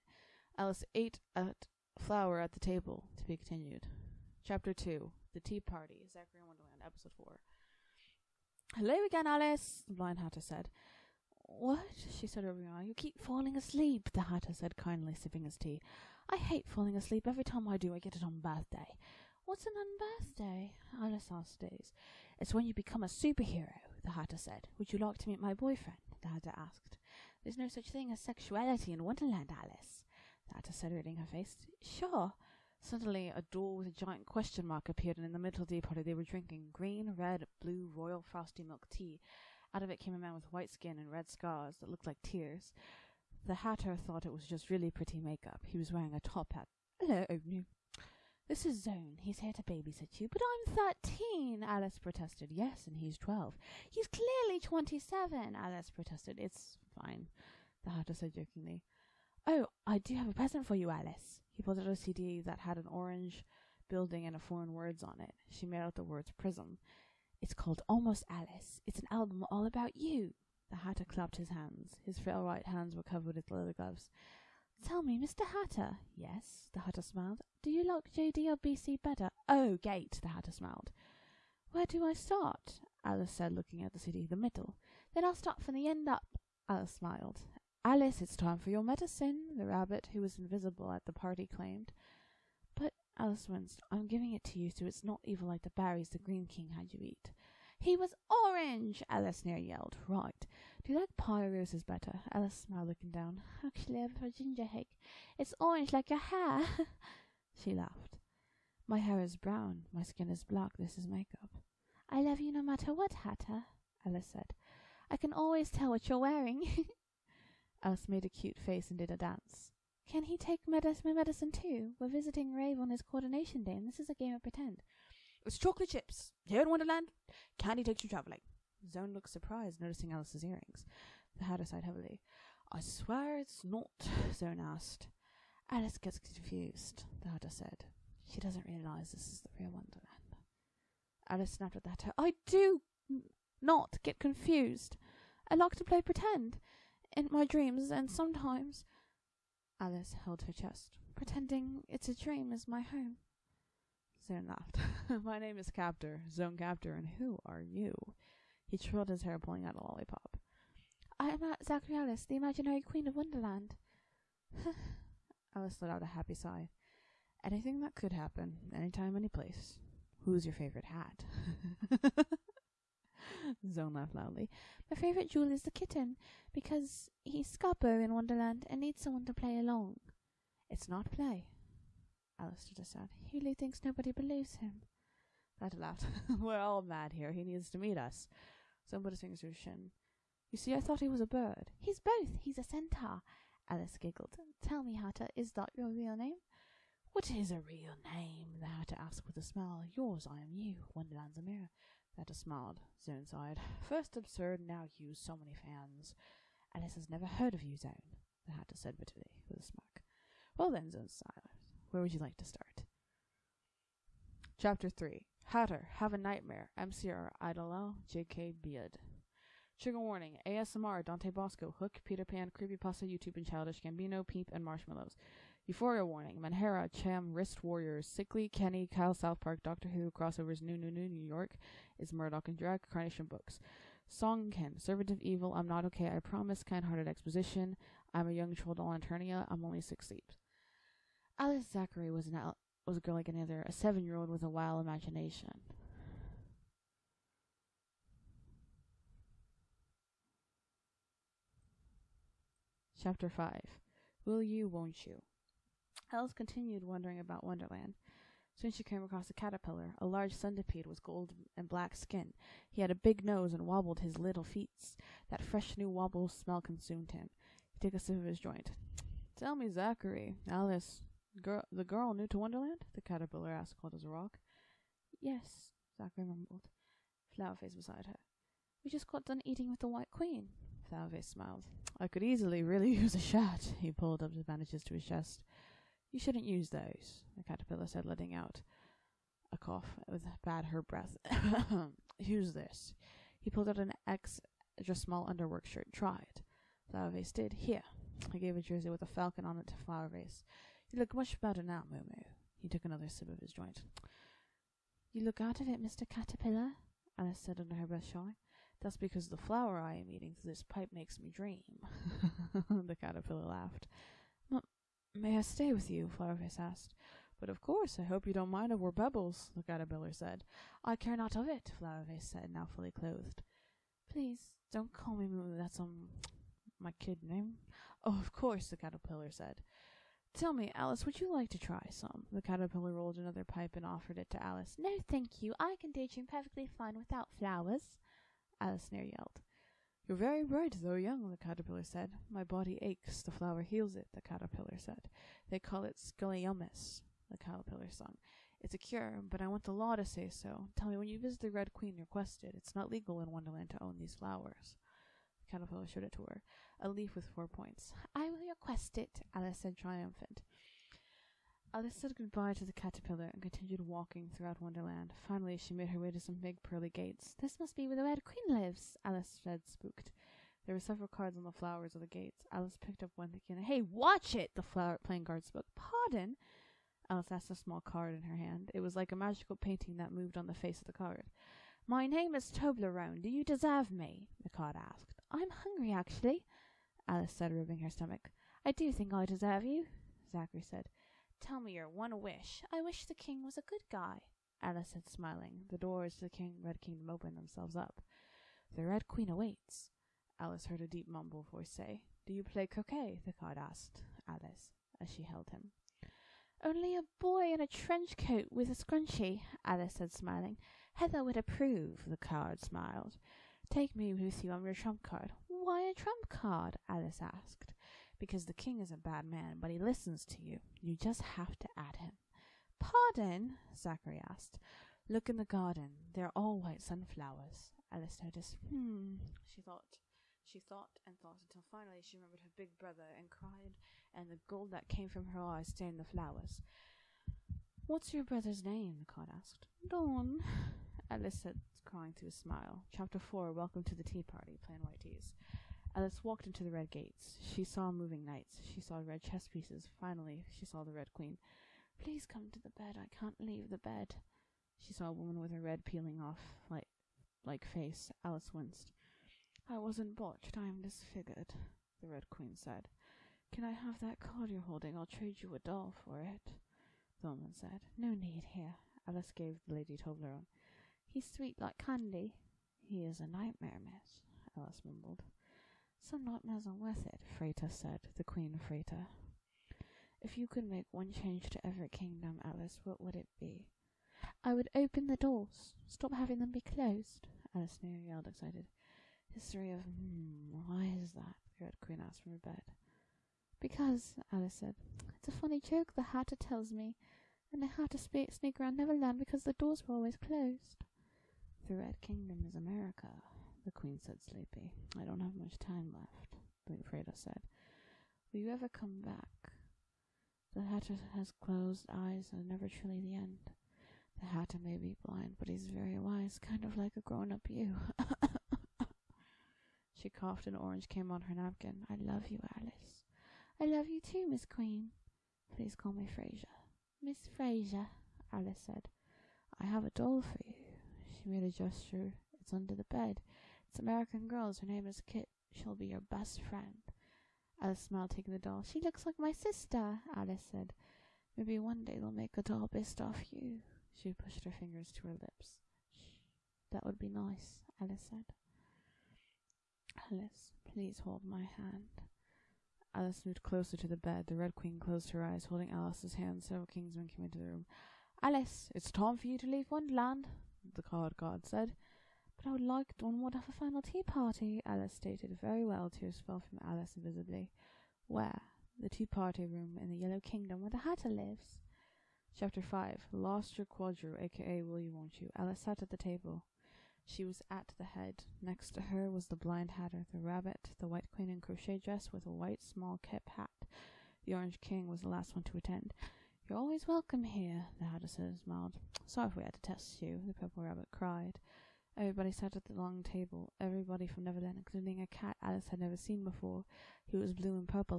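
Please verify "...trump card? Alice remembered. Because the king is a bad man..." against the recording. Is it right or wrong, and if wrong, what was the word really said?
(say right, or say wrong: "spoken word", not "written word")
wrong: "asked", not "remembered".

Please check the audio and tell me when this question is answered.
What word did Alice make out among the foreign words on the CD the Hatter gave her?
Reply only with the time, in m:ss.
1:06.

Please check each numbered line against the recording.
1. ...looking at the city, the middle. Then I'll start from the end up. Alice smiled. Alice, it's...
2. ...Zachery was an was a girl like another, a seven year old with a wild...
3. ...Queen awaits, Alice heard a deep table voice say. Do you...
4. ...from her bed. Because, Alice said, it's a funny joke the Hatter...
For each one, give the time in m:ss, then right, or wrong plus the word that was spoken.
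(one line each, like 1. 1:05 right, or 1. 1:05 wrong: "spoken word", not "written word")
1. 1:23 right
2. 4:01 right
3. 6:39 wrong: "mumble", not "table"
4. 8:12 right.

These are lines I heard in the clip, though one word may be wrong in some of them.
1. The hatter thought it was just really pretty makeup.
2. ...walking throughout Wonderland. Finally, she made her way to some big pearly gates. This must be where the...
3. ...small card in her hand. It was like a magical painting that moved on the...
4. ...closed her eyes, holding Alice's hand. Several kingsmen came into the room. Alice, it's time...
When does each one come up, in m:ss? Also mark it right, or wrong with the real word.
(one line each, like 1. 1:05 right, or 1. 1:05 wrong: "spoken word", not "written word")
1. 0:43 right
2. 6:03 right
3. 6:17 right
4. 9:14 right.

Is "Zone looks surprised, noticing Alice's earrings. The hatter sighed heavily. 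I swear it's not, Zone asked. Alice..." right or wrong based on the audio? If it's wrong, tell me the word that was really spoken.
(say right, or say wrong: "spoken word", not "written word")
right.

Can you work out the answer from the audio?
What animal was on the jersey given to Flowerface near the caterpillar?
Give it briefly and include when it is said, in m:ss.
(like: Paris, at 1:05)
falcon, at 4:59.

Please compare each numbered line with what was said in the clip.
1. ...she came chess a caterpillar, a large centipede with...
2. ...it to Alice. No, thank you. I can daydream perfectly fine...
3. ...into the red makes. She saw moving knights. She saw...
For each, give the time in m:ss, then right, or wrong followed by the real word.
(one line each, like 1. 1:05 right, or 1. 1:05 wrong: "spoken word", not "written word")
1. 4:18 wrong: "across", not "chess"
2. 5:34 right
3. 7:26 wrong: "gates", not "makes".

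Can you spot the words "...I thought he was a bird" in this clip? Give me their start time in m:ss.
3:10.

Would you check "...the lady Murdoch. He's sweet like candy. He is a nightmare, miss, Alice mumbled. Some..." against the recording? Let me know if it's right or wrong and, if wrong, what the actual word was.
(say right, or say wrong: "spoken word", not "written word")
wrong: "Toblerone", not "Murdoch".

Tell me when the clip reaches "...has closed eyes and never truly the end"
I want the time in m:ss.
8:31.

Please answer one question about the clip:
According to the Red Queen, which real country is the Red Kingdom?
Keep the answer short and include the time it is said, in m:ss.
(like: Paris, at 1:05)
America, at 8:22.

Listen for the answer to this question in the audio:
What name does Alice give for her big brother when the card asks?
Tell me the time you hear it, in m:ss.
7:19.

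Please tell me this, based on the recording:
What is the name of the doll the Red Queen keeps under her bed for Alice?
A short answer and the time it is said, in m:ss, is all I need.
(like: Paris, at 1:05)
Kit, at 8:55.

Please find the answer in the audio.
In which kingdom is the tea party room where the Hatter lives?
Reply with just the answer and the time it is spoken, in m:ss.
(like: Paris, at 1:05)
Yellow Kingdom, at 9:29.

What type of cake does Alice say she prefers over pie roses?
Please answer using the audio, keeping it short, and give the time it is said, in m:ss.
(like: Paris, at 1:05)
ginger cake, at 1:44.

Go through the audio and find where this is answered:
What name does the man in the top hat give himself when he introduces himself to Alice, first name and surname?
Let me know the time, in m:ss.
2:36.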